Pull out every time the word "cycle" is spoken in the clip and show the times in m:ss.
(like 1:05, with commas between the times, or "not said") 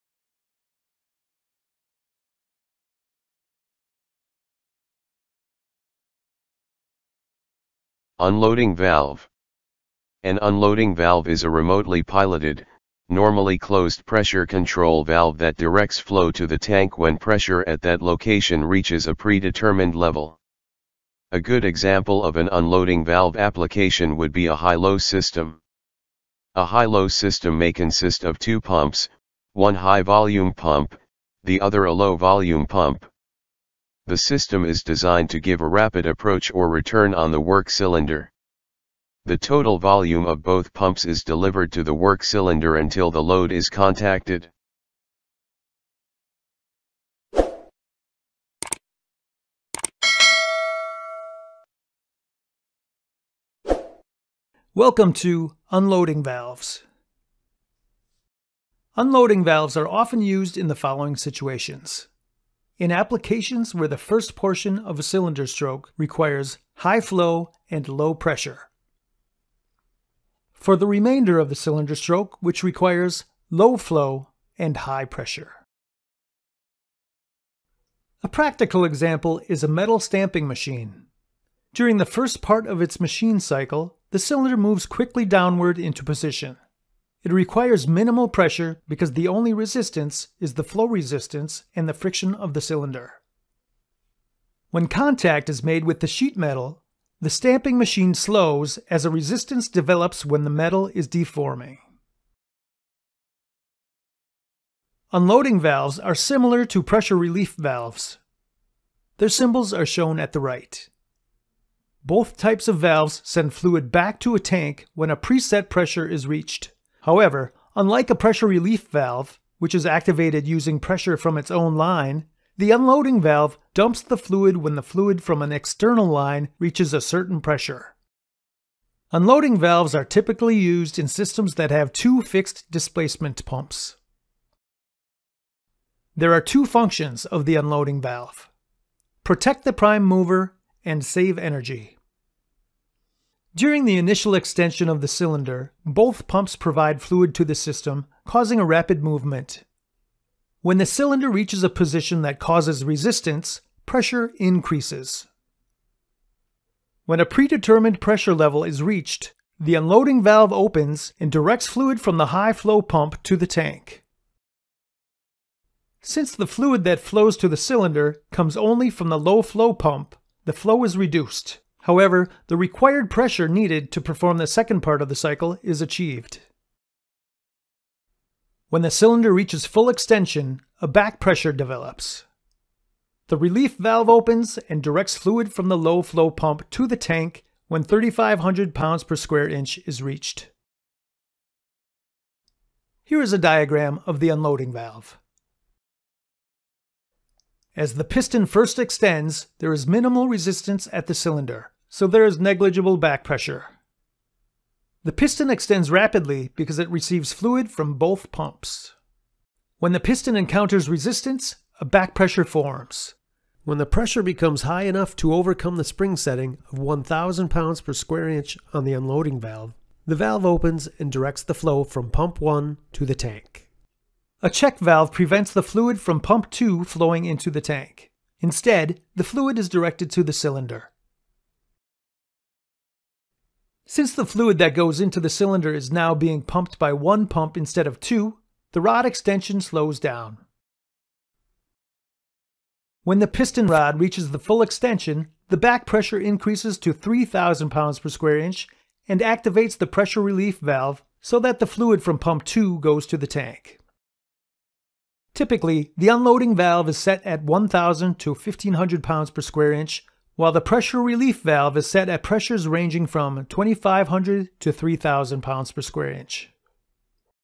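1:23, 2:55.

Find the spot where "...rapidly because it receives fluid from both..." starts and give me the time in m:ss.
3:25.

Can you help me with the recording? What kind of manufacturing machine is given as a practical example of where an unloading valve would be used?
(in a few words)
metal stamping machine.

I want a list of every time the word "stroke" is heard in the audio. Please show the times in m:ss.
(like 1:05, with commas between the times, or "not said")
1:05, 1:11.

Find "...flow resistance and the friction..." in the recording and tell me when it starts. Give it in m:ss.
1:30.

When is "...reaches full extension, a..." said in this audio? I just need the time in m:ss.
2:59.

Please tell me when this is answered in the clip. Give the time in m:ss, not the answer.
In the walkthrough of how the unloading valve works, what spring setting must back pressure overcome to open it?
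3:36.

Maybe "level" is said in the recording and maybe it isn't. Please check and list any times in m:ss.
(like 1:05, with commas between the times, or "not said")
0:19, 2:38.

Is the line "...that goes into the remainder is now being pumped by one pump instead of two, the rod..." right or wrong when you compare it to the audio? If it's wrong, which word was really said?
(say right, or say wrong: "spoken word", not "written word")
wrong: "cylinder", not "remainder".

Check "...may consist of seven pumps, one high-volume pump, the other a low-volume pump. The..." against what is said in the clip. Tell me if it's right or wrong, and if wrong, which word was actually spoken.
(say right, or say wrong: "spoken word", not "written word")
wrong: "two", not "seven".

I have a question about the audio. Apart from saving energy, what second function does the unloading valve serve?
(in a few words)
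Protect the prime mover.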